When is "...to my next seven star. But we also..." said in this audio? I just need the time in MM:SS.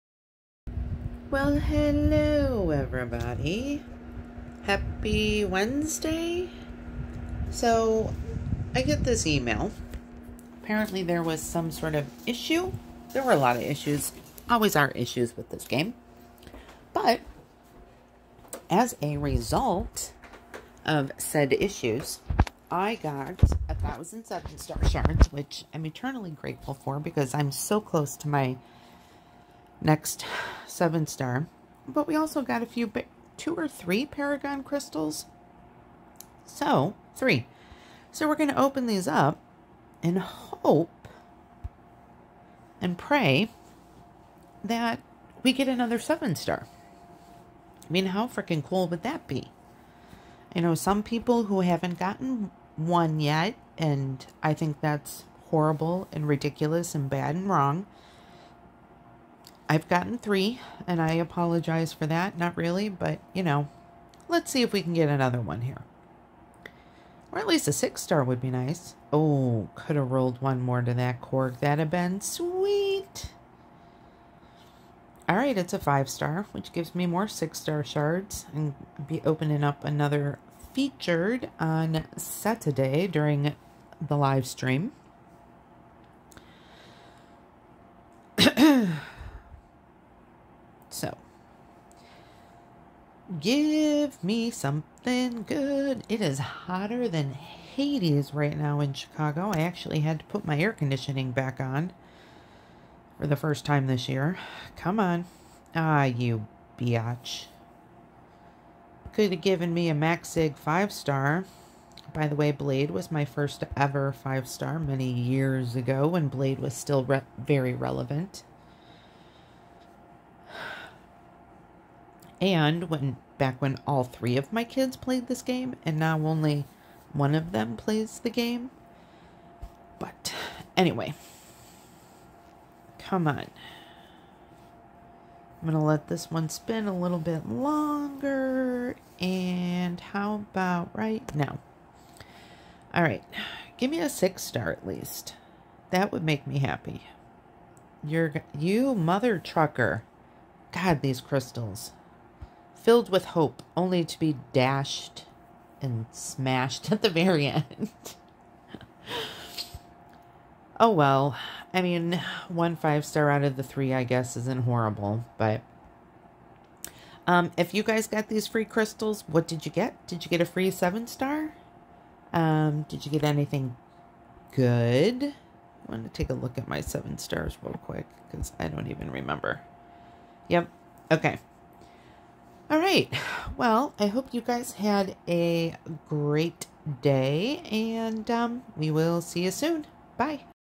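00:28.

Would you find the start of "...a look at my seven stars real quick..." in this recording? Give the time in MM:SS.
02:56.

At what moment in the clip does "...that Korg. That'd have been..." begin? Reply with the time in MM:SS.
01:10.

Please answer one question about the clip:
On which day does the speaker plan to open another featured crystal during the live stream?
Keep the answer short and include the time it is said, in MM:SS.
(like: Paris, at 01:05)
Saturday, at 01:22.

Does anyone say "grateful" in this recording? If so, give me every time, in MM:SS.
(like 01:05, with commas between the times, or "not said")
00:26.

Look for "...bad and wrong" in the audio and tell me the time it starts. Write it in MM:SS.
00:57.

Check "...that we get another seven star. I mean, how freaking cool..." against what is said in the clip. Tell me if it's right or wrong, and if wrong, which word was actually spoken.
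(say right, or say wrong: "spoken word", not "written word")
right.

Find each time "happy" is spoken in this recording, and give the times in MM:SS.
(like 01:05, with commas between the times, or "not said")
00:04, 02:26.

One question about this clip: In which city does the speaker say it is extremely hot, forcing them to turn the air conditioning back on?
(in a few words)
Chicago.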